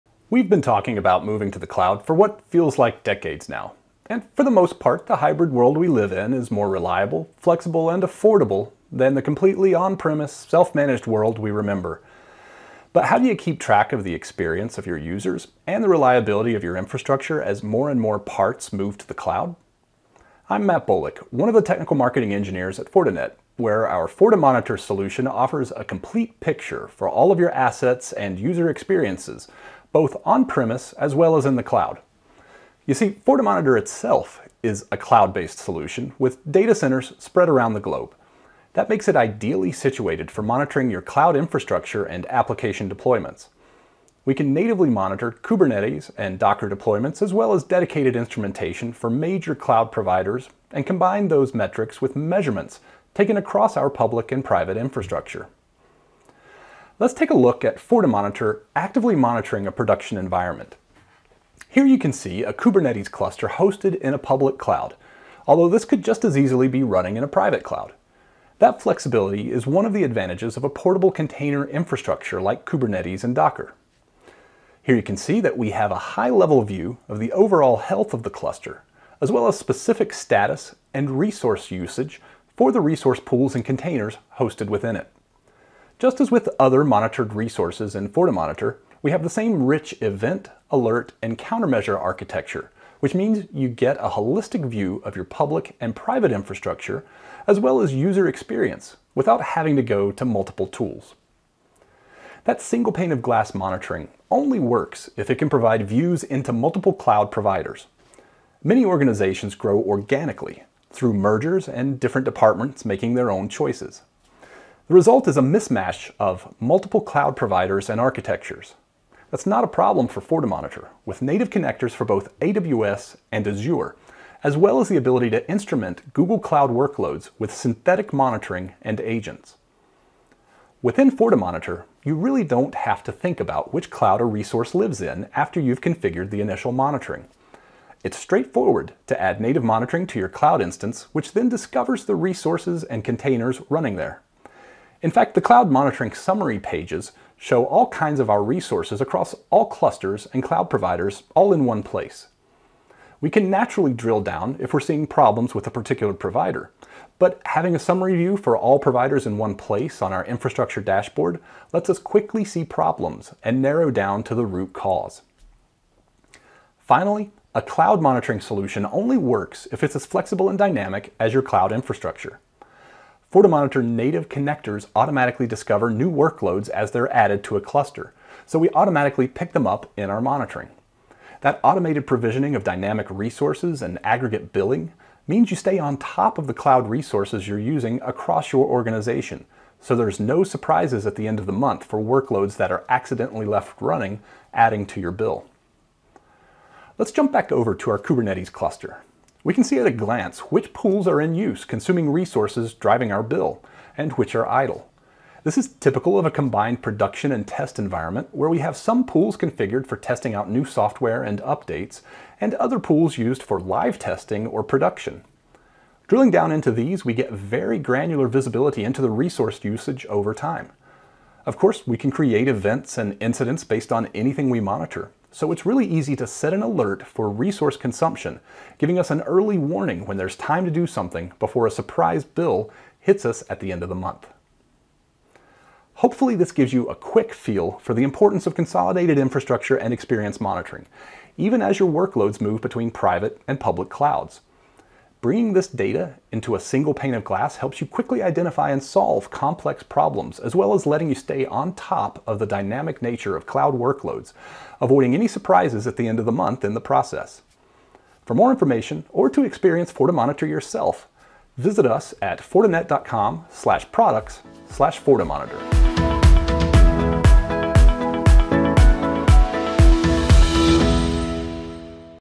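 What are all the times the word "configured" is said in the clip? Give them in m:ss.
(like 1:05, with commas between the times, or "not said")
2:15, 3:29.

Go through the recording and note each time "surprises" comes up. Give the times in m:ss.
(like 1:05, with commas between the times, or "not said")
3:10, 3:51, 4:15.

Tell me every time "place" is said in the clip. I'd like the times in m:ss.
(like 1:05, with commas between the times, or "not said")
2:31, 2:39.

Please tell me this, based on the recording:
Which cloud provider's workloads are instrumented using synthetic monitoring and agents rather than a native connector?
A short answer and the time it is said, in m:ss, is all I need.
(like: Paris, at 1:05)
Google Cloud, at 2:06.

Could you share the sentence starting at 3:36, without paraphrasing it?
Drilling down into these, we get very granular visibility into the resource usage over time.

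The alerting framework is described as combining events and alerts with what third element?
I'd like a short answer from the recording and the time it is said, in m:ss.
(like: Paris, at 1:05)
Countermeasure, at 1:31.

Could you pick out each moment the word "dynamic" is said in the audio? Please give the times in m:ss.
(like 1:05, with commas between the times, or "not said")
2:50, 3:02, 4:12.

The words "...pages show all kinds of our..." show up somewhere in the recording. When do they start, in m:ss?
2:26.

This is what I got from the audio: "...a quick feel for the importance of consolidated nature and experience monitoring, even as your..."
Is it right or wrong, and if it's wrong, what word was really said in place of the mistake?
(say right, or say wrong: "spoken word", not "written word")
wrong: "infrastructure", not "nature".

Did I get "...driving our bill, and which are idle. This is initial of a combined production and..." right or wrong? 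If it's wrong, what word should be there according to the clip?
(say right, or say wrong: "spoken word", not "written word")
wrong: "typical", not "initial".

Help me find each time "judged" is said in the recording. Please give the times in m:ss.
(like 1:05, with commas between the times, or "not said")
not said.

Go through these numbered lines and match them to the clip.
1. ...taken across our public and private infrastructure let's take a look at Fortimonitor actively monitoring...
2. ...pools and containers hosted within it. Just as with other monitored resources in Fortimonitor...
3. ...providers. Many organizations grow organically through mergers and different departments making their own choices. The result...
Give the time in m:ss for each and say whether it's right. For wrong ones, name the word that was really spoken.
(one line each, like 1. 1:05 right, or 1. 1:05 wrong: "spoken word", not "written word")
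1. 0:53 right
2. 1:23 right
3. 1:47 right.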